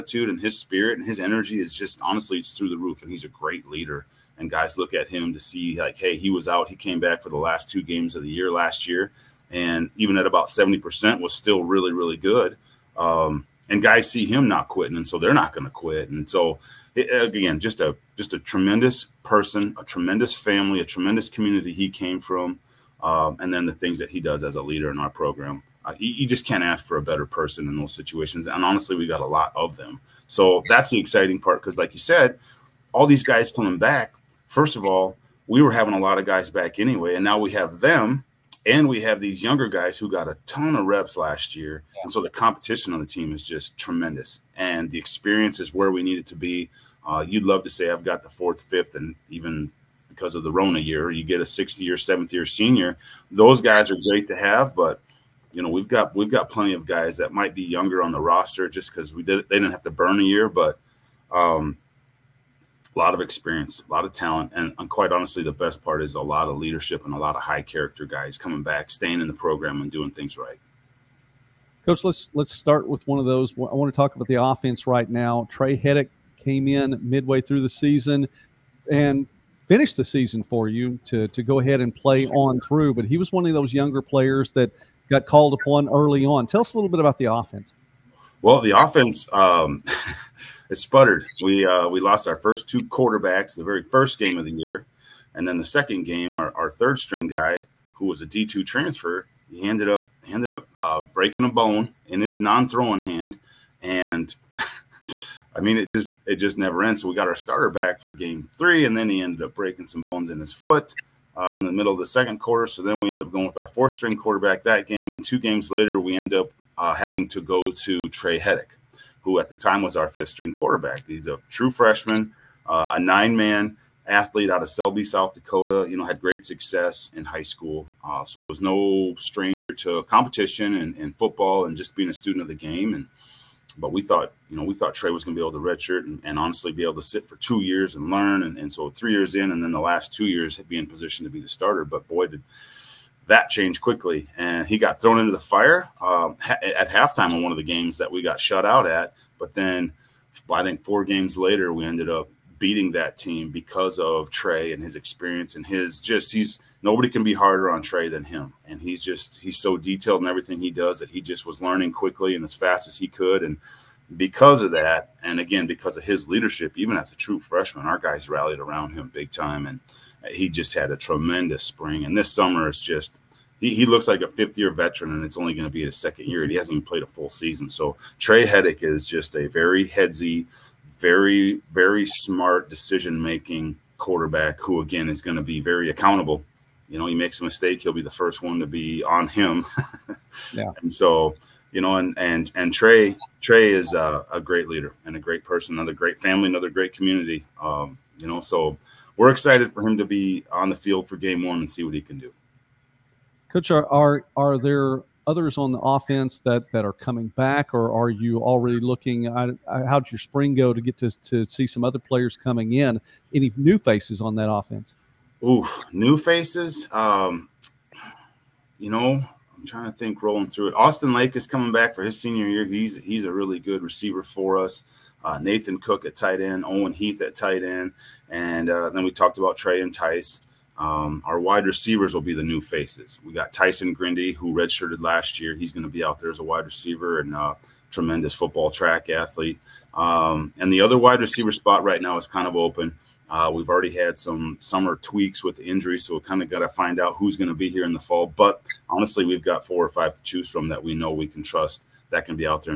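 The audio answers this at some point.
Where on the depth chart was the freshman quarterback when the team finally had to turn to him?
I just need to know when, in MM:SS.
02:00.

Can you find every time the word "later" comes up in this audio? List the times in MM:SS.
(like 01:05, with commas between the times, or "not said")
01:55, 02:31.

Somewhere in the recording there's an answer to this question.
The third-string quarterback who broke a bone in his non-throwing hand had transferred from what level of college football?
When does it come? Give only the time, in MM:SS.
01:38.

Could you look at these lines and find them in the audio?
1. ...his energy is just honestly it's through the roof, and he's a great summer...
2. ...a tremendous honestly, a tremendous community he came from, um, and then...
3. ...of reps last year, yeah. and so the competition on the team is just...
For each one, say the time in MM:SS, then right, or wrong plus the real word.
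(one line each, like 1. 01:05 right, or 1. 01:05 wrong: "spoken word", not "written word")
1. 00:01 wrong: "leader", not "summer"
2. 00:19 wrong: "family", not "honestly"
3. 00:40 right.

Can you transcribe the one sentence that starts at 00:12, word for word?
Um, and guys see him not quitting, and so they're not going to quit.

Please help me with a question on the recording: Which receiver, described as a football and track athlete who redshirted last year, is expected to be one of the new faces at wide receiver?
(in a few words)
Tyson Grindy.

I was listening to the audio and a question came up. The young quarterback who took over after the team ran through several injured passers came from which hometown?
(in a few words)
Selby, South Dakota.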